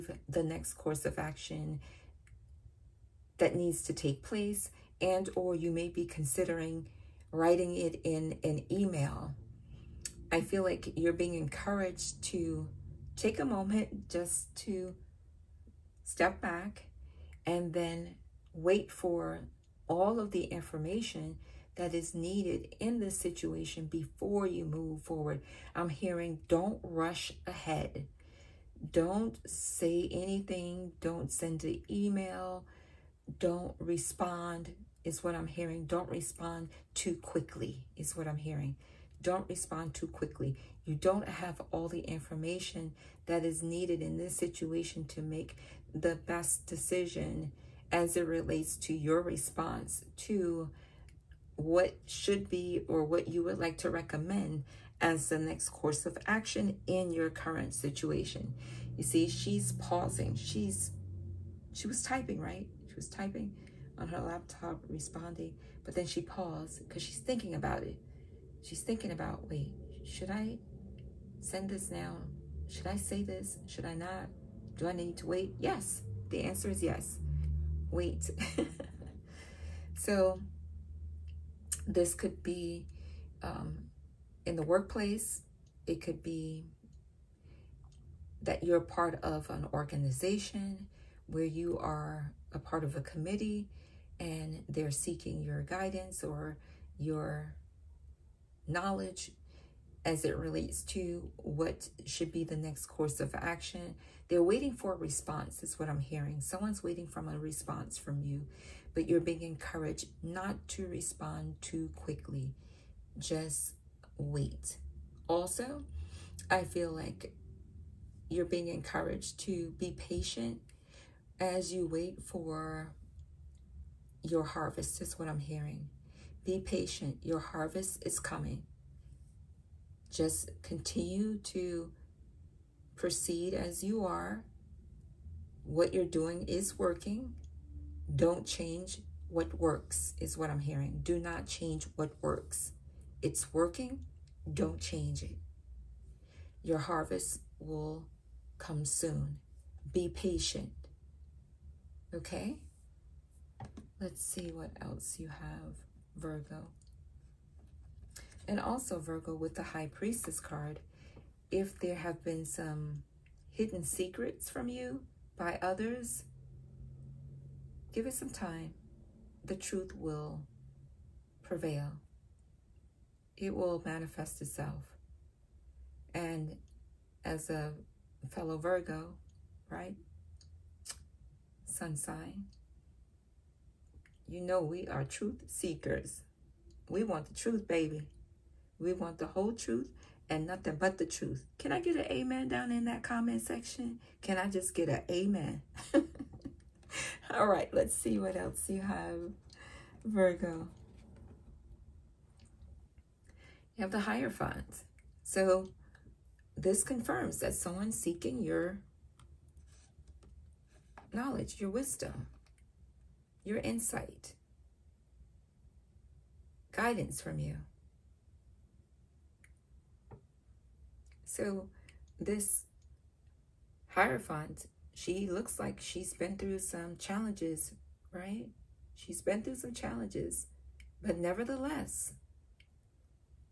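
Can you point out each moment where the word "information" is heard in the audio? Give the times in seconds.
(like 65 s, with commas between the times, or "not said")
20 s, 42 s.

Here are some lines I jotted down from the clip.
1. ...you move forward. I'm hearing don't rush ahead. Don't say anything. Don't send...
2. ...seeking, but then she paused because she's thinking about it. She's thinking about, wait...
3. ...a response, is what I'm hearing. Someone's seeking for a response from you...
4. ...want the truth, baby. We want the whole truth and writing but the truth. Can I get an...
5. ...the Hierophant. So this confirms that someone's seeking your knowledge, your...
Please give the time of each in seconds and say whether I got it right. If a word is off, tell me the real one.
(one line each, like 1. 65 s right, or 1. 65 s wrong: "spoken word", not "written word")
1. 24 s right
2. 64 s wrong: "responding", not "seeking"
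3. 104 s wrong: "waiting", not "seeking"
4. 187 s wrong: "nothing", not "writing"
5. 203 s right.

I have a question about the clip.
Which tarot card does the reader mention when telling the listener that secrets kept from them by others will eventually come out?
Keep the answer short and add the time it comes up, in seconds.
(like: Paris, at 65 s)
High Priestess, at 159 s.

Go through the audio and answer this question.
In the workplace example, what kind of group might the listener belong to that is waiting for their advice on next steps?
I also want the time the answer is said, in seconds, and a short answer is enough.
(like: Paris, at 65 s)
A committee, at 93 s.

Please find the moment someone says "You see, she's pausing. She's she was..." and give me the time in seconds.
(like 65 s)
58 s.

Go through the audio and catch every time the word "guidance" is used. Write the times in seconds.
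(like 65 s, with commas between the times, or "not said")
95 s, 216 s.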